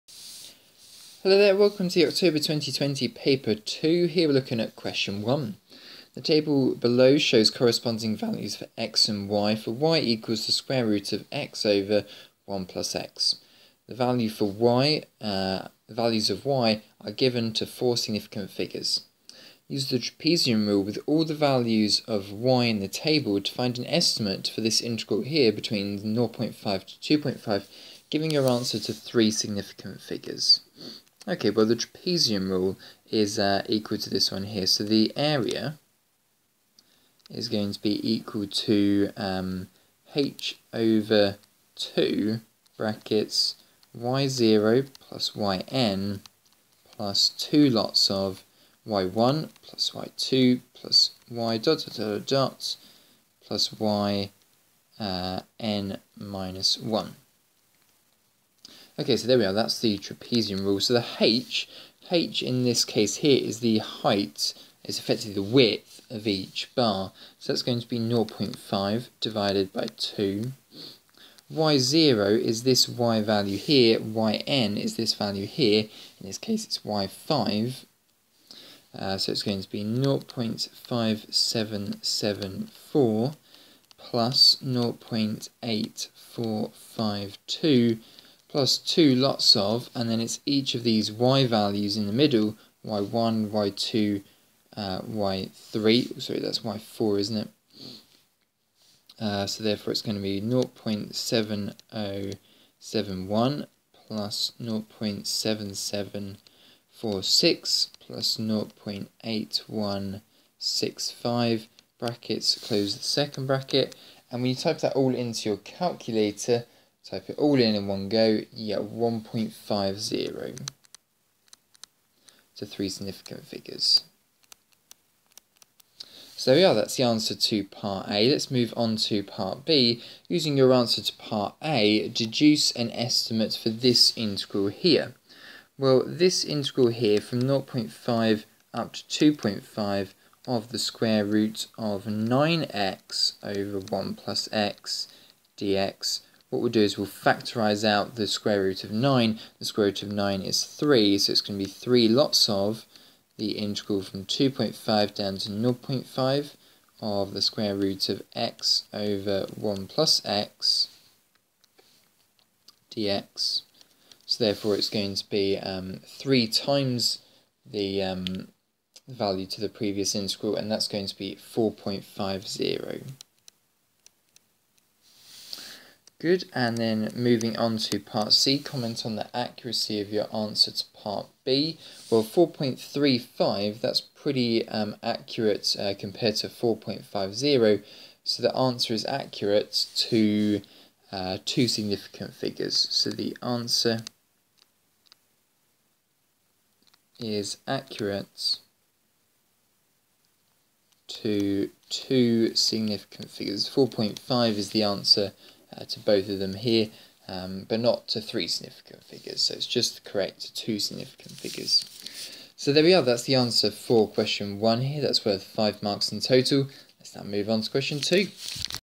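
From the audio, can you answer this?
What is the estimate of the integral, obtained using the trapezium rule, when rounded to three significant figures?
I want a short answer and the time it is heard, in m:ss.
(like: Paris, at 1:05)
1.50, at 1:58.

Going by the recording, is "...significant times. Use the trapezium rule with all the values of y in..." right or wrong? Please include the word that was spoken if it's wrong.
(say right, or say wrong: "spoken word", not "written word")
wrong: "figures", not "times".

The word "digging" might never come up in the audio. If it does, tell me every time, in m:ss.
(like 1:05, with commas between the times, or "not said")
not said.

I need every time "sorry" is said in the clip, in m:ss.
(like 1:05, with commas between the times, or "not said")
1:36.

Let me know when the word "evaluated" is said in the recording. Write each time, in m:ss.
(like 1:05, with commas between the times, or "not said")
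not said.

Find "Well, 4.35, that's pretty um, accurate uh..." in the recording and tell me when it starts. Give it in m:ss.
3:02.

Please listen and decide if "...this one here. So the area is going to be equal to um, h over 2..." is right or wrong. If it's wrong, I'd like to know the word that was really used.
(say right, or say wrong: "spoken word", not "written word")
right.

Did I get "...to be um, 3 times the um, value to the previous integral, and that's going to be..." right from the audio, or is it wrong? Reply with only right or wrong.
right.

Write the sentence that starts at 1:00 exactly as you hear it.
So the h, h in this case here is the height, is effectively the width of each bar.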